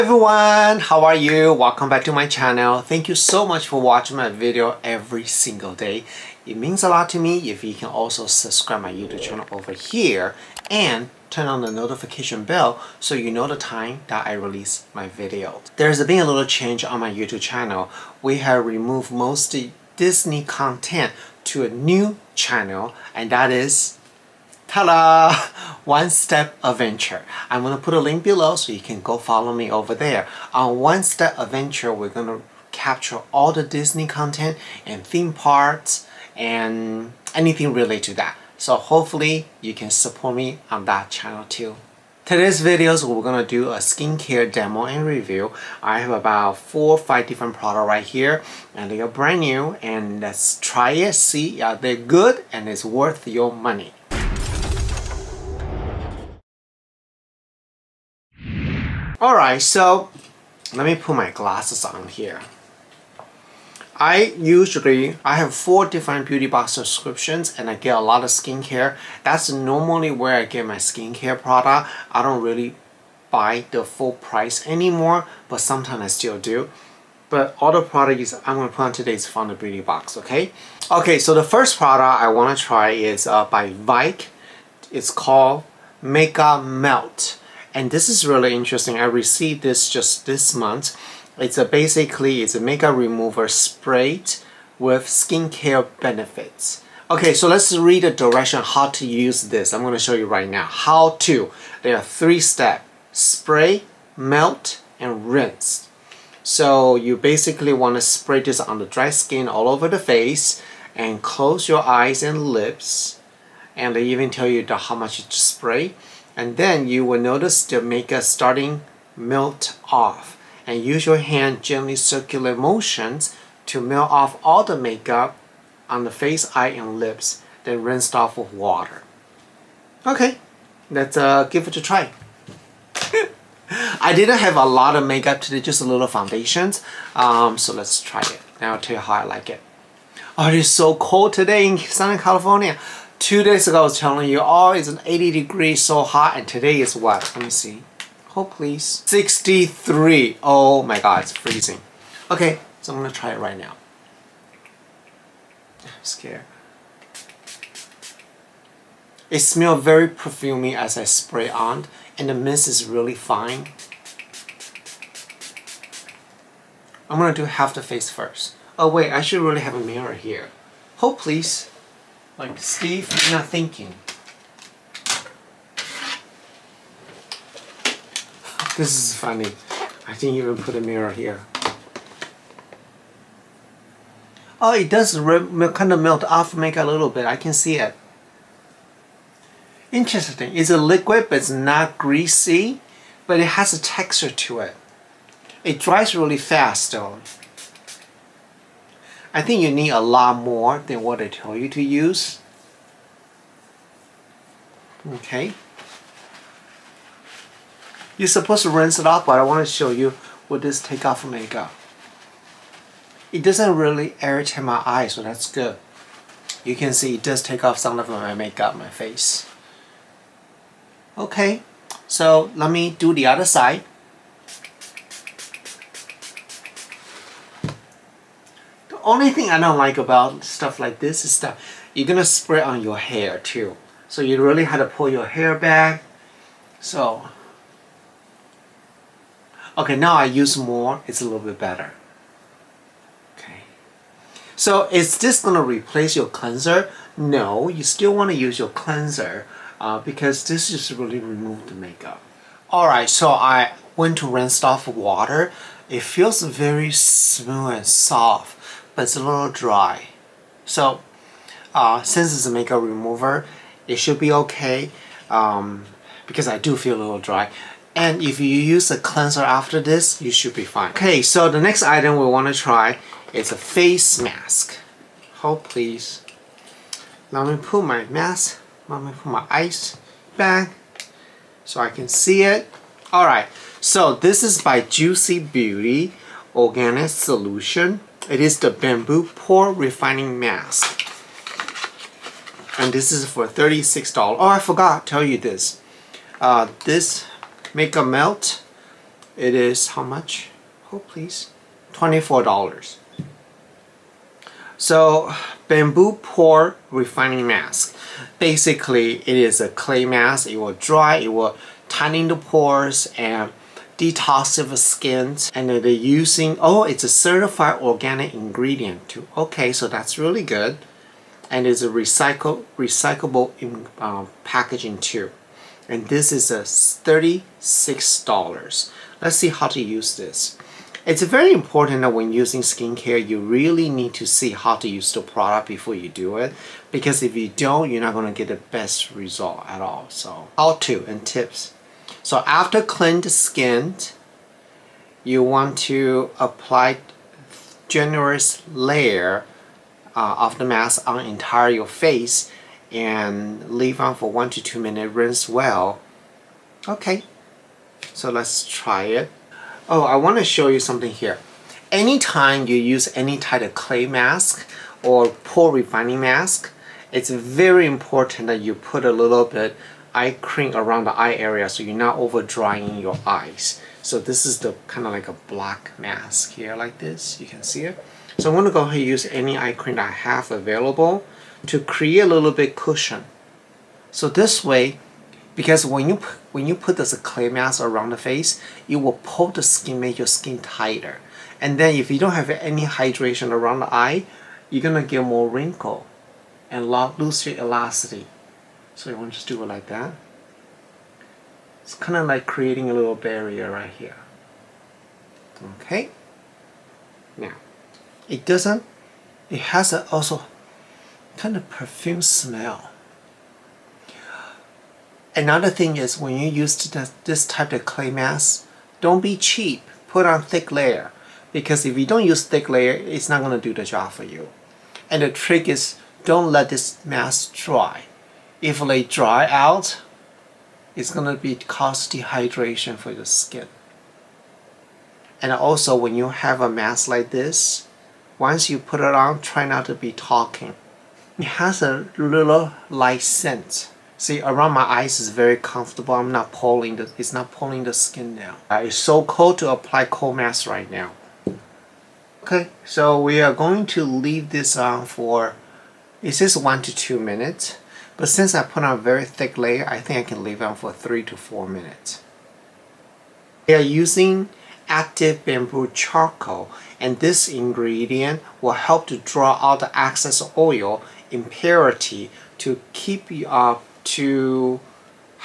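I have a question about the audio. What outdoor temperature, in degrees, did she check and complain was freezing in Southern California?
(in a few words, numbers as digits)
63.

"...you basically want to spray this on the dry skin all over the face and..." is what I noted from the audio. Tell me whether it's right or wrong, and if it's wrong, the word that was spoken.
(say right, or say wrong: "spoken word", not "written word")
right.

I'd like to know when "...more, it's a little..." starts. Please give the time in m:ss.
4:00.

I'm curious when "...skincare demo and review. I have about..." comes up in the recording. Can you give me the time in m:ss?
0:43.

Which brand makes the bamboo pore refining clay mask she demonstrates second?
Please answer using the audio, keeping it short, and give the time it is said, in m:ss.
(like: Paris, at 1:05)
Juice Beauty, at 4:44.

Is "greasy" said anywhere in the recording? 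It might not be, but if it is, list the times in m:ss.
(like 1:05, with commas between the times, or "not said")
3:11.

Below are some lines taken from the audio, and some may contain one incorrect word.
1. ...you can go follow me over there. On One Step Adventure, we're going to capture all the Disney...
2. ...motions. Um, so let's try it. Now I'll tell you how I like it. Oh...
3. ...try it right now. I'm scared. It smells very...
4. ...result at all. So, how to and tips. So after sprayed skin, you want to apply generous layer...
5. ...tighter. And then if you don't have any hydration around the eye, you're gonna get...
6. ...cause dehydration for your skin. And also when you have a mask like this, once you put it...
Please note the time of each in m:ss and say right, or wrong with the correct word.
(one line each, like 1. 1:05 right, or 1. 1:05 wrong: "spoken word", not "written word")
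1. 0:28 right
2. 2:16 wrong: "foundations", not "motions"
3. 2:33 right
4. 5:39 wrong: "cleaned", not "sprayed"
5. 6:30 right
6. 7:11 right.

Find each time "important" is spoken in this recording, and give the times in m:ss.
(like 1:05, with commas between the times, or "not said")
5:31, 6:07.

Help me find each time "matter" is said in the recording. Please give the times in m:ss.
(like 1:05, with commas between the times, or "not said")
not said.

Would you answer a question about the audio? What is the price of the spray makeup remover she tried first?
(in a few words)
$24.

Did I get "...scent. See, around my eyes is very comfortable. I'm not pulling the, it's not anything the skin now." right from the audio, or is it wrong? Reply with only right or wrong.
wrong.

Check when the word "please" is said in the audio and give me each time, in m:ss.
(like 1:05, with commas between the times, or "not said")
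2:28, 2:51, 4:35, 5:00.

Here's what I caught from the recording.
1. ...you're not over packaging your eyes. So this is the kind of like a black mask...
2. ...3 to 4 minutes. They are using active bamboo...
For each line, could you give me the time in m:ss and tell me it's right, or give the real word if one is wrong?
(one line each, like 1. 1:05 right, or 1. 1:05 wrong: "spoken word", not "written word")
1. 6:11 wrong: "drying", not "packaging"
2. 7:40 right.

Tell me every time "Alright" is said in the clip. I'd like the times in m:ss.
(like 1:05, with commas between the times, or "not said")
0:59, 4:12, 4:43.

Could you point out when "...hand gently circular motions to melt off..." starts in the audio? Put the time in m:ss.
2:01.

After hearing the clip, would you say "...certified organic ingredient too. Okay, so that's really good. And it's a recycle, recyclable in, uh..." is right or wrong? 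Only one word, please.
right.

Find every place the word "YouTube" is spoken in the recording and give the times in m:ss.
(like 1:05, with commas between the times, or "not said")
0:08, 0:17.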